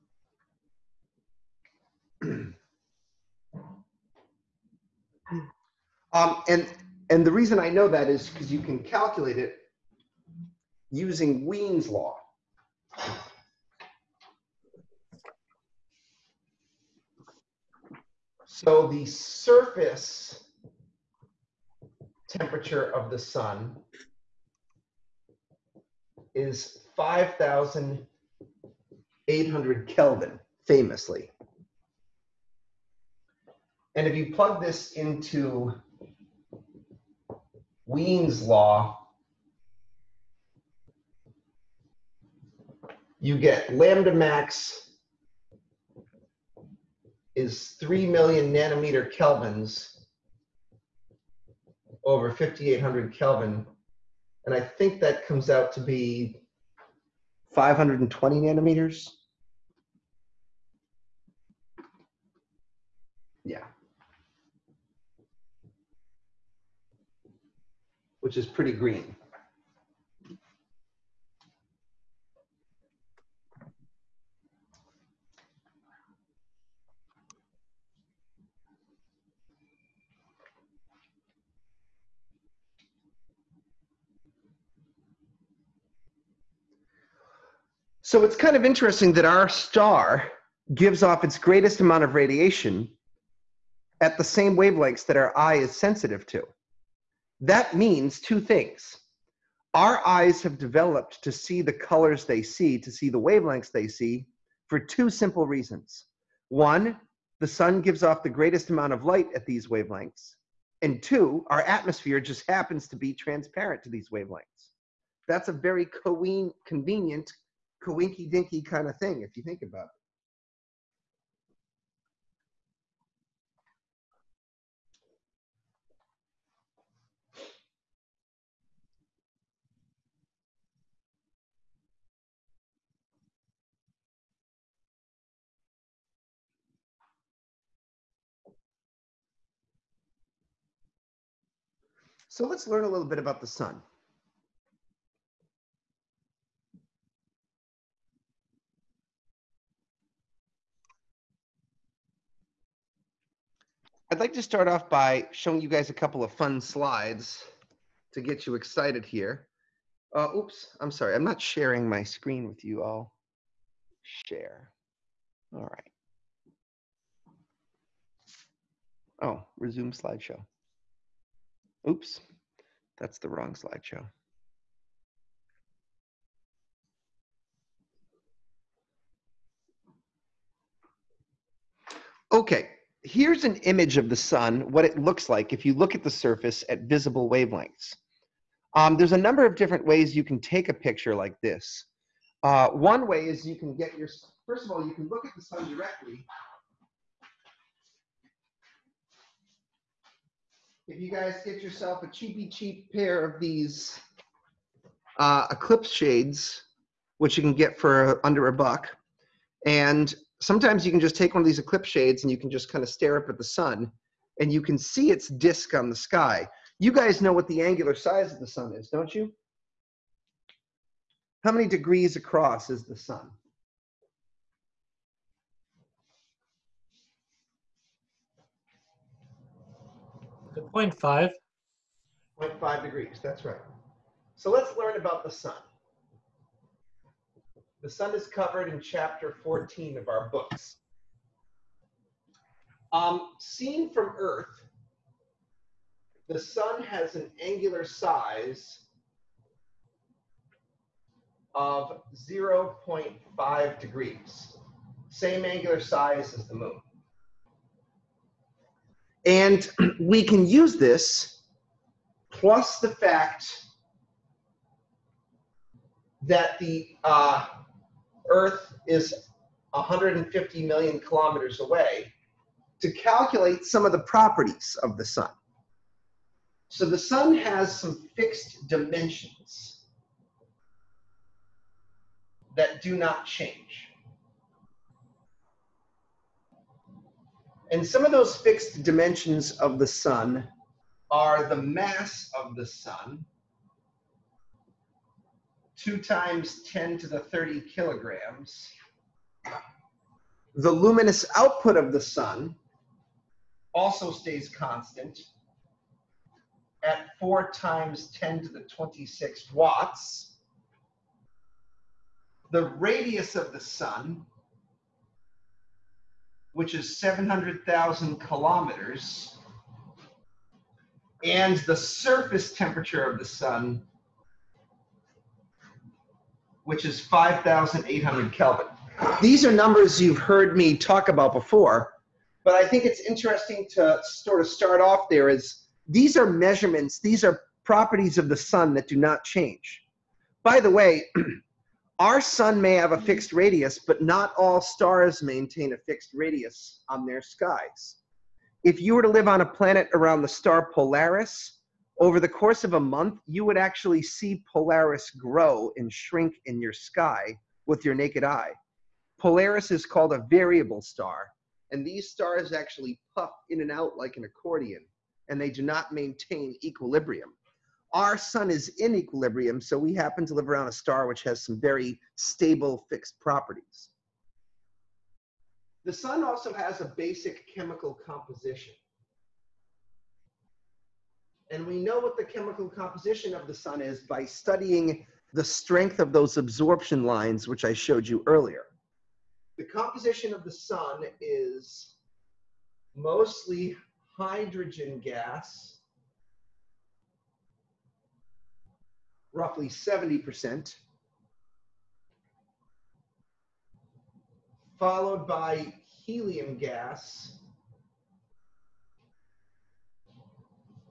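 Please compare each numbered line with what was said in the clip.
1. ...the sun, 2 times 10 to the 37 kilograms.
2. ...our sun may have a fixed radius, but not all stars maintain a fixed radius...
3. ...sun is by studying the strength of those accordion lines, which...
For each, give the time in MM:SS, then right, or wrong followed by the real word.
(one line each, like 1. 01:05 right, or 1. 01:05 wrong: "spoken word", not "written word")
1. 04:52 wrong: "30", not "37"
2. 05:41 right
3. 06:23 wrong: "absorption", not "accordion".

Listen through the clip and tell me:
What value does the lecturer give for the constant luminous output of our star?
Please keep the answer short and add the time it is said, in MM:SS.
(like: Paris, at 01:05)
4 times 10 to the 26 watts, at 05:07.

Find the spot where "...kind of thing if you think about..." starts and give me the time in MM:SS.
01:58.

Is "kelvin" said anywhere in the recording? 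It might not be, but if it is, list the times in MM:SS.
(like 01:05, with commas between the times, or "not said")
00:29, 00:49, 00:53, 05:28.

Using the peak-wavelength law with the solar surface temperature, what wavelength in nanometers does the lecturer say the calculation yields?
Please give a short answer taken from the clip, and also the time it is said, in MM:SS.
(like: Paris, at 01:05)
520 nanometers, at 00:57.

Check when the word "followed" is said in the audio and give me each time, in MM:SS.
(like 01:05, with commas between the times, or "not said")
06:44.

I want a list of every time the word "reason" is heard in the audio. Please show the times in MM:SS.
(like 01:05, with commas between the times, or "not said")
00:07, 01:45.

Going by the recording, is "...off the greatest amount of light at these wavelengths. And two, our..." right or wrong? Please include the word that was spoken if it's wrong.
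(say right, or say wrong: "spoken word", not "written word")
right.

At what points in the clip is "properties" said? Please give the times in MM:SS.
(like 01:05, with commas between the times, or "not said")
04:33, 05:37, 06:13.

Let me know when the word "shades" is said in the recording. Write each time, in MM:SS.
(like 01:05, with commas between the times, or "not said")
03:25, 03:31.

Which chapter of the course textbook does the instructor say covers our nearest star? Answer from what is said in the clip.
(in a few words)
chapter 14.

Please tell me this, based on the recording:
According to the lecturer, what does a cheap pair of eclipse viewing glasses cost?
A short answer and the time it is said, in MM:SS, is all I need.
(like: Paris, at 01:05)
under a buck, at 03:28.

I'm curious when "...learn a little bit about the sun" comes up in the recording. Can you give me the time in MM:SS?
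02:22.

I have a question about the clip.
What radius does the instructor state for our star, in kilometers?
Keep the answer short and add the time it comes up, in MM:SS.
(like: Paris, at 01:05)
700,000 kilometers, at 05:16.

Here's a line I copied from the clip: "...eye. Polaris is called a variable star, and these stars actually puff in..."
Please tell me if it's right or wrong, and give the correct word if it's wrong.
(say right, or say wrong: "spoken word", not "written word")
right.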